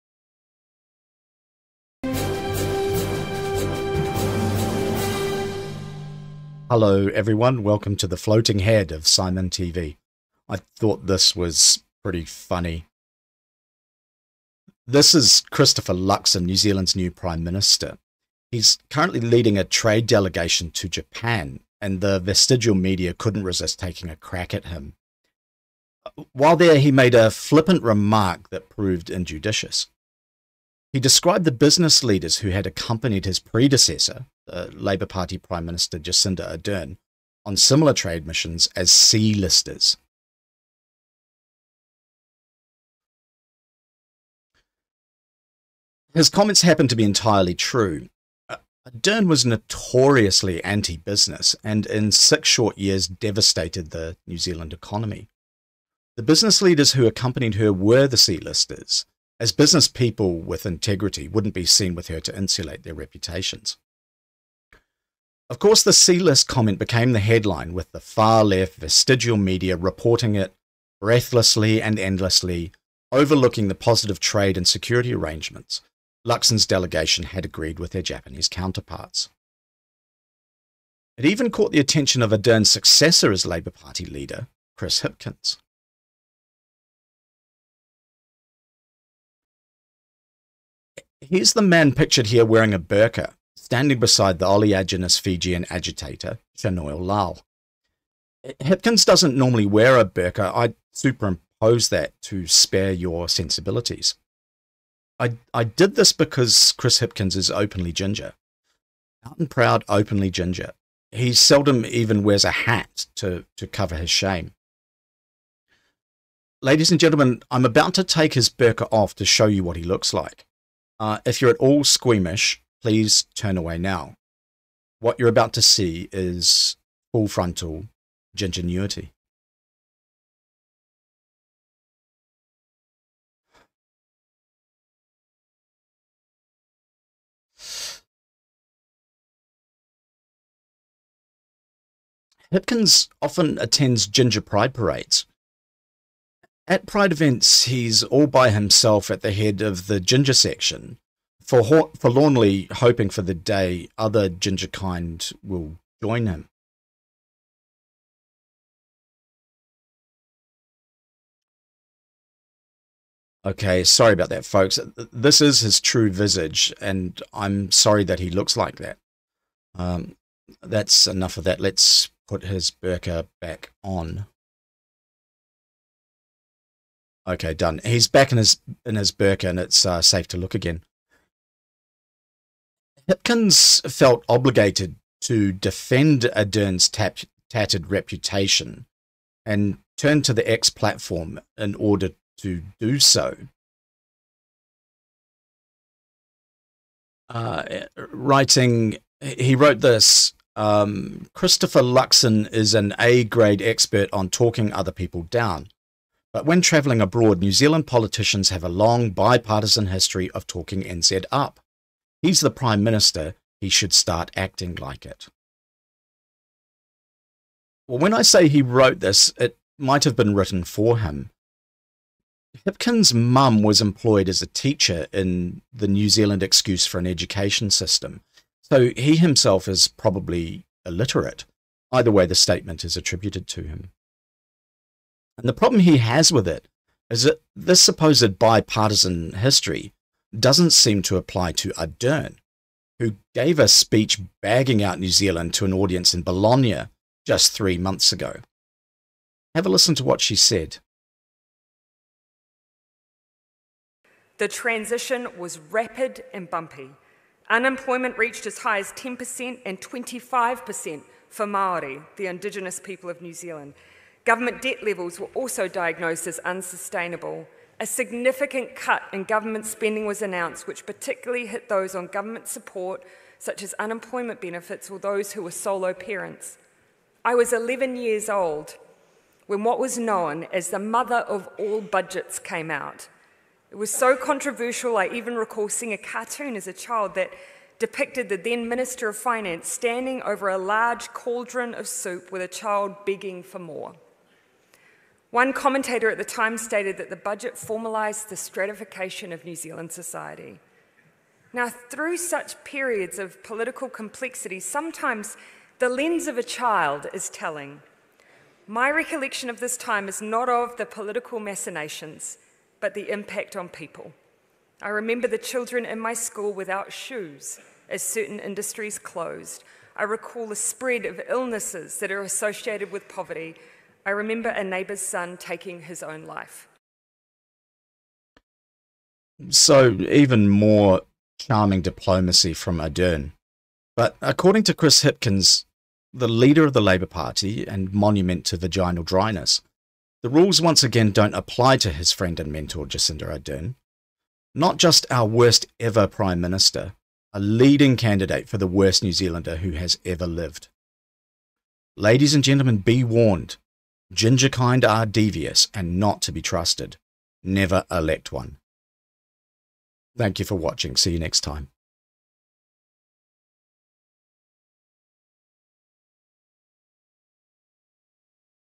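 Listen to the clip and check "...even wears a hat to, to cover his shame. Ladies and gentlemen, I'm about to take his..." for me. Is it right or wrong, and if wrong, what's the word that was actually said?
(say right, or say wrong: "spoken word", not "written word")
right.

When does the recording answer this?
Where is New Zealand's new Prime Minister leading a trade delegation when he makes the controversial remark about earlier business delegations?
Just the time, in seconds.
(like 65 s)
20 s.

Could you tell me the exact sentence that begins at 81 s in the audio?
It even caught the attention of Ardern's successor as Labour Party leader, Chris Hipkins.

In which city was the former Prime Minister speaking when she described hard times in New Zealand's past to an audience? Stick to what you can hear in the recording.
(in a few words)
Bologna.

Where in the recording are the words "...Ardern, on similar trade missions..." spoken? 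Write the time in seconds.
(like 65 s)
36 s.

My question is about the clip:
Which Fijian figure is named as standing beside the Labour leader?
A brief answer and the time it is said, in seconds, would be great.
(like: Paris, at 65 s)
Shanoil Lal, at 96 s.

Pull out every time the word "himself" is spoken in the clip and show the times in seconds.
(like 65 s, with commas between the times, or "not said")
148 s, 229 s.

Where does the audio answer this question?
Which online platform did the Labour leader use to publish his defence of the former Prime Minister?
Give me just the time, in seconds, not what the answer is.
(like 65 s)
190 s.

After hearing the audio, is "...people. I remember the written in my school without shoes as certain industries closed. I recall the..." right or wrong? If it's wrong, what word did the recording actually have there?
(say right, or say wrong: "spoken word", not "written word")
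wrong: "children", not "written".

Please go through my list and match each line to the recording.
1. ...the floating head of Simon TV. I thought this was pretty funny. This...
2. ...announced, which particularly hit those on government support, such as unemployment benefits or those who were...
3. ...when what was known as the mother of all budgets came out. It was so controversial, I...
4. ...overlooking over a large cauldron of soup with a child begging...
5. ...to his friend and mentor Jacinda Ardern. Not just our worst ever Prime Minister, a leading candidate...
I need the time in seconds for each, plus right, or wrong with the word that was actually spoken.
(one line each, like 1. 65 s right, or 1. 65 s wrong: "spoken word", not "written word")
1. 8 s right
2. 270 s right
3. 279 s right
4. 289 s wrong: "standing", not "overlooking"
5. 341 s right.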